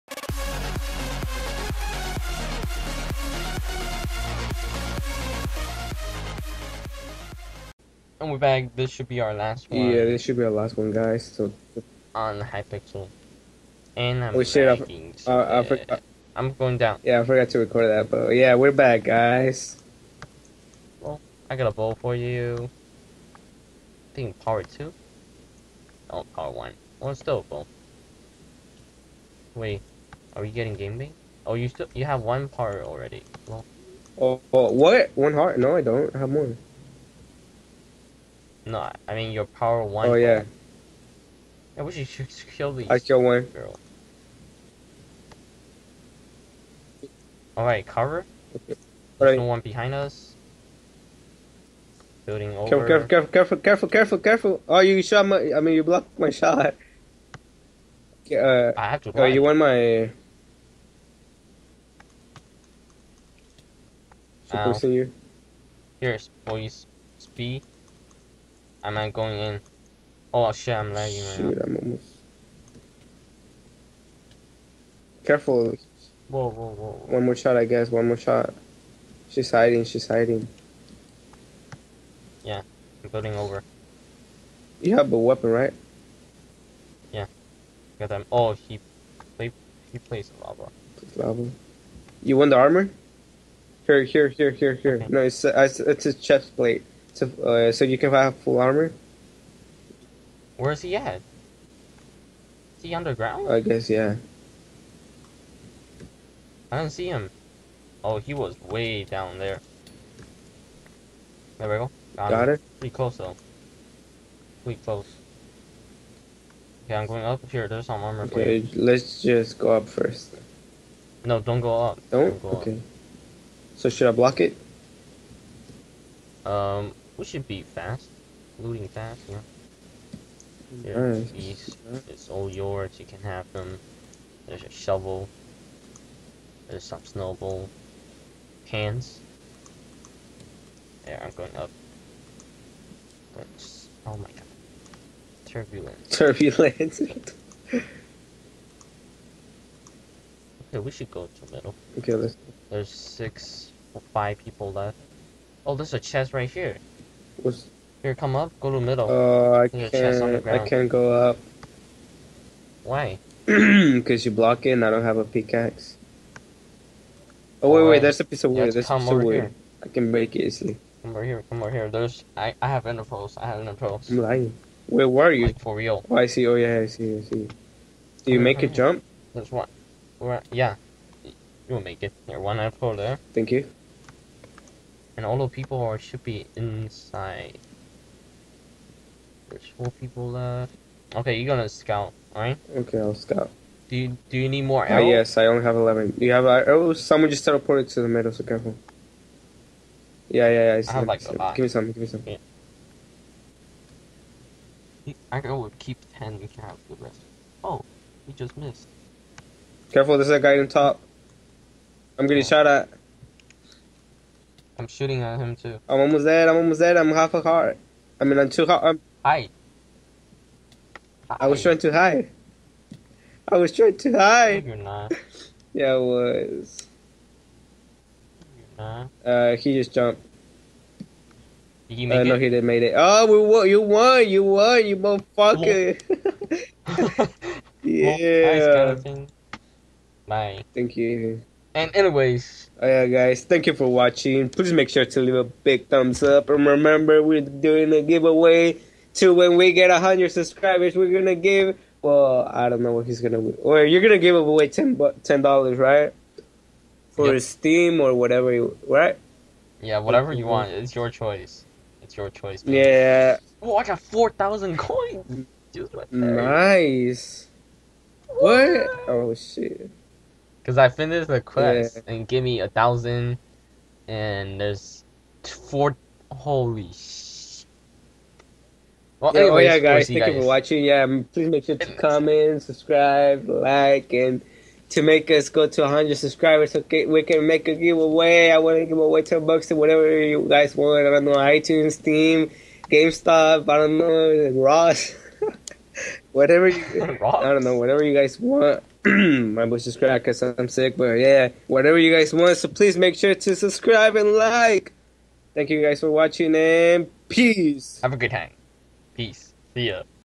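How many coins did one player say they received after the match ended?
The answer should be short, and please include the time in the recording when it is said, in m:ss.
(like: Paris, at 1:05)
4000, at 4:23.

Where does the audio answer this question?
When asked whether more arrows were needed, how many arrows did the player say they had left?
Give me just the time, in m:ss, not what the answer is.
3:15.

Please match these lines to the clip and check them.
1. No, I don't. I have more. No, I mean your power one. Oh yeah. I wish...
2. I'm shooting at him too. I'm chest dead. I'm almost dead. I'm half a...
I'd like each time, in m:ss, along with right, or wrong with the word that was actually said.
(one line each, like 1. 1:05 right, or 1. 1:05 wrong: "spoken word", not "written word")
1. 0:35 right
2. 3:34 wrong: "almost", not "chest".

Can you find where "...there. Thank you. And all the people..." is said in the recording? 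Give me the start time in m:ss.
3:02.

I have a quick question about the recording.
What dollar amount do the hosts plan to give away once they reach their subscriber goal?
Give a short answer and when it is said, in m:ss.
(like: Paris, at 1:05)
10 dollars, at 4:14.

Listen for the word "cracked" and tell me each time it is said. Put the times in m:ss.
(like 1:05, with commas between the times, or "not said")
4:59.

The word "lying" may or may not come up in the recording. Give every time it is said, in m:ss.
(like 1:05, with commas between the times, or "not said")
2:54.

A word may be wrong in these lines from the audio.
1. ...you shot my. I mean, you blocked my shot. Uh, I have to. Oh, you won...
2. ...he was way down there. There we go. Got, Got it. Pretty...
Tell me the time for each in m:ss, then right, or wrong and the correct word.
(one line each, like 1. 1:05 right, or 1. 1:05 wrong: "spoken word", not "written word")
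1. 0:54 right
2. 1:48 right.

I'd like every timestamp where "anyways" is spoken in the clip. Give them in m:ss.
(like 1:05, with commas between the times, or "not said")
4:01, 4:39.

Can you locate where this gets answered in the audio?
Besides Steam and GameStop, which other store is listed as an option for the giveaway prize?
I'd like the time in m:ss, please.
4:51.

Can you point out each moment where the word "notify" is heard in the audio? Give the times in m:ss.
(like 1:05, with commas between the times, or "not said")
not said.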